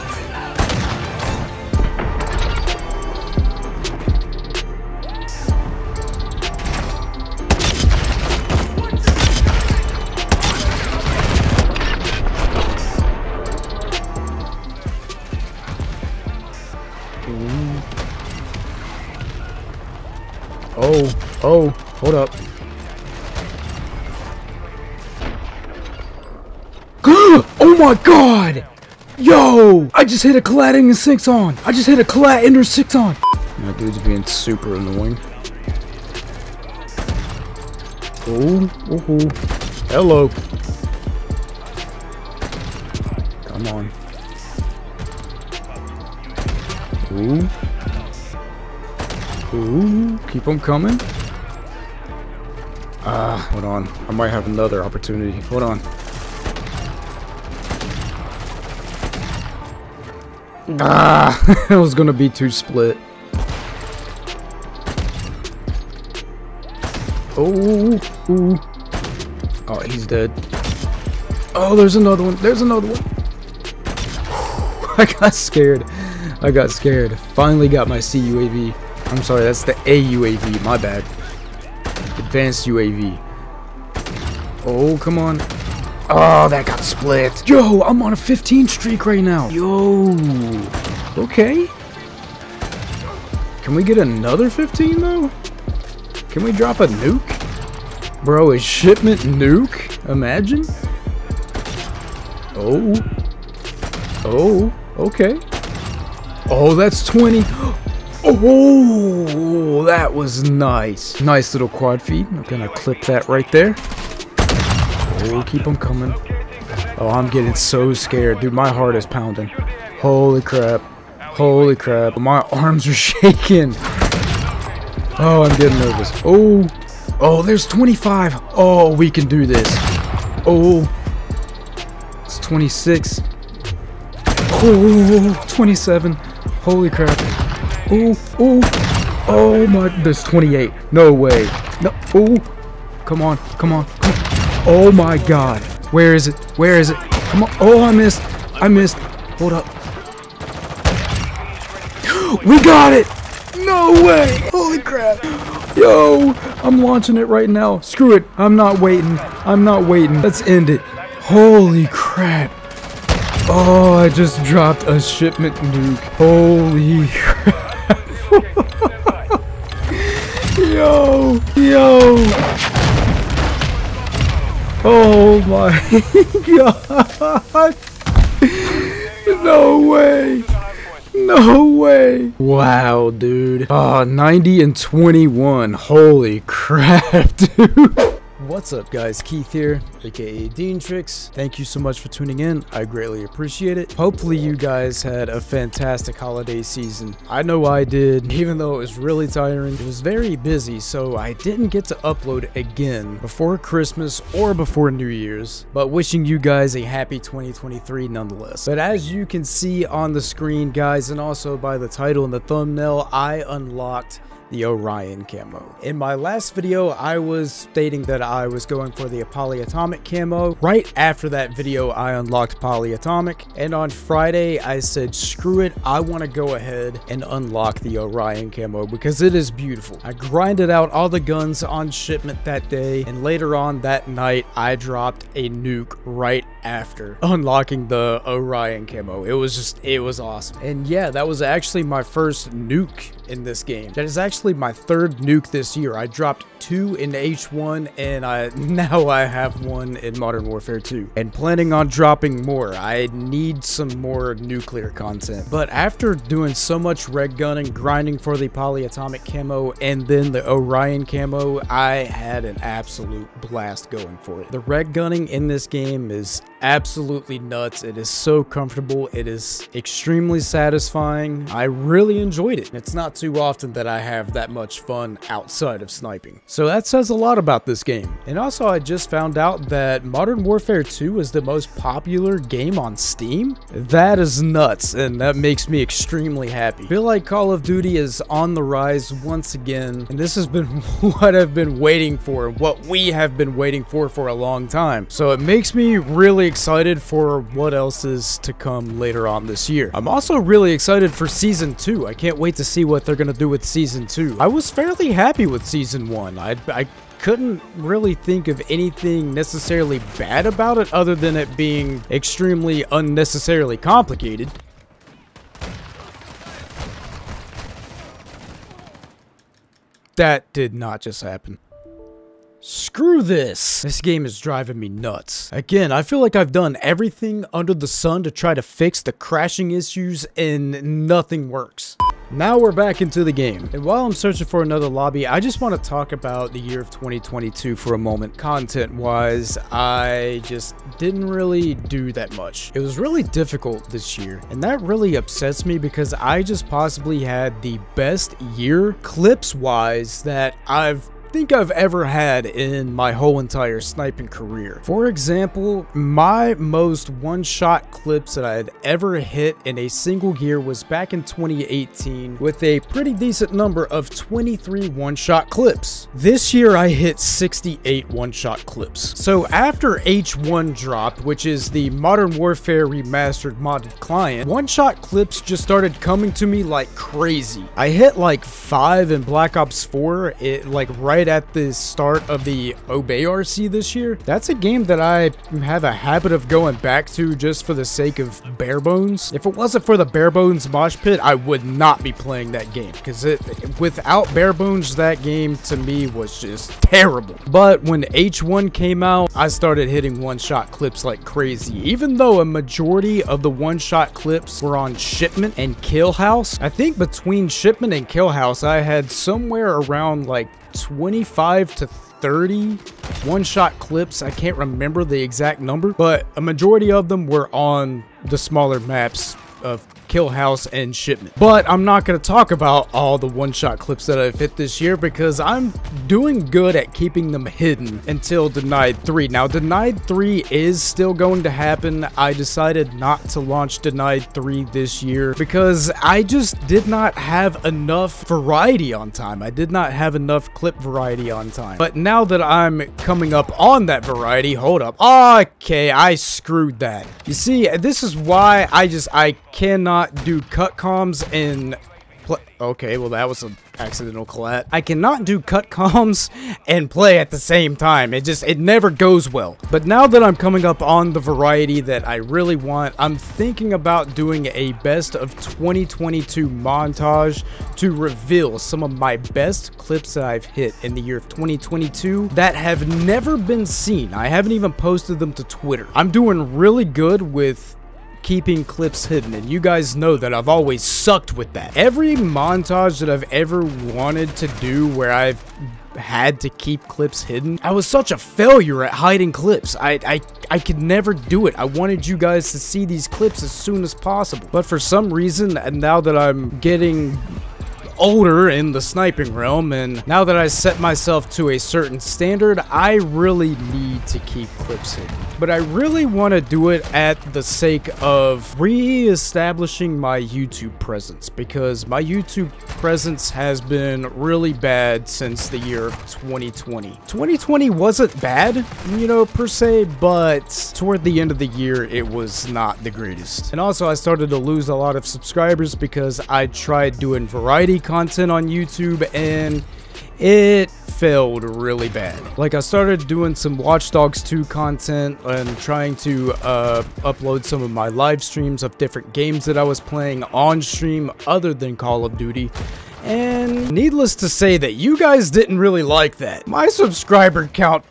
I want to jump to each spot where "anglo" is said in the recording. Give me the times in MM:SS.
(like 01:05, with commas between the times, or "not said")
not said.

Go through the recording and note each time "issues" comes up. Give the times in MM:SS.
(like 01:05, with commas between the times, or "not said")
05:29.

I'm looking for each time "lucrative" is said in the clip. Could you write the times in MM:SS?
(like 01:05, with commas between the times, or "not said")
not said.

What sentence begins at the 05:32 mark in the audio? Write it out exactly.
Now we're back into the game.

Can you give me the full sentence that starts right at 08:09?
I, I, I could never do it.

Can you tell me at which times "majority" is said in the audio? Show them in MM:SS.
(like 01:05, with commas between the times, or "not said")
06:42, 06:56.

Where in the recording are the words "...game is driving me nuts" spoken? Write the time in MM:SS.
05:23.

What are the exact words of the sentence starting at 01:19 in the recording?
I'm sorry, that's the AUAV, my bad.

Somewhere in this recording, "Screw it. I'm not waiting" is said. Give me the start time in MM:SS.
02:37.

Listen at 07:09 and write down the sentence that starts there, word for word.
Now, Denied 3 is still going to happen.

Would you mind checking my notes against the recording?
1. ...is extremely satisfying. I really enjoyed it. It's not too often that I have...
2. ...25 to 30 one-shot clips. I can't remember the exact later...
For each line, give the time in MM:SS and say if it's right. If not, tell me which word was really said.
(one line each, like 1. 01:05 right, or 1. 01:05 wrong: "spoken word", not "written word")
1. 04:29 right
2. 06:51 wrong: "number", not "later".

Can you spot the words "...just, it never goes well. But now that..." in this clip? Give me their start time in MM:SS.
07:38.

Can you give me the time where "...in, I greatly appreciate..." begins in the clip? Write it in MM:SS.
03:12.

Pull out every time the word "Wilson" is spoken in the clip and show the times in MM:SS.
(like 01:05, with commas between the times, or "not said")
not said.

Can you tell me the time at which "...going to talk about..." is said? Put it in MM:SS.
07:02.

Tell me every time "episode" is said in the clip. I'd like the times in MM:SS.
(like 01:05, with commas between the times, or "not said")
not said.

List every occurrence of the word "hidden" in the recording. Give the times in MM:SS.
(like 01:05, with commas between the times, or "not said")
07:07, 07:59, 08:07, 08:24.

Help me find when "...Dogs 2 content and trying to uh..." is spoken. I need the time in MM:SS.
08:53.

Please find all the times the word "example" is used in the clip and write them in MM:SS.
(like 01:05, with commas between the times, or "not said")
05:55.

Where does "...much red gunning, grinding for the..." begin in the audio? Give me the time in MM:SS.
04:16.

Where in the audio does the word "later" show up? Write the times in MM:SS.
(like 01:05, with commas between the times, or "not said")
03:53, 04:58.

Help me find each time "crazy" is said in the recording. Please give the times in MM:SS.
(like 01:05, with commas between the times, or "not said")
06:16, 06:41.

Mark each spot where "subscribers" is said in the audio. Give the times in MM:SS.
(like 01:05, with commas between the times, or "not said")
08:45, 09:06.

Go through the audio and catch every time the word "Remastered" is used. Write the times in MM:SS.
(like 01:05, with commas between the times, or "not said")
06:12.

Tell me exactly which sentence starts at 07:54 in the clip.
I haven't even posted them to Twitter.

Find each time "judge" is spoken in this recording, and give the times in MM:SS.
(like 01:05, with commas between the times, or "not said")
not said.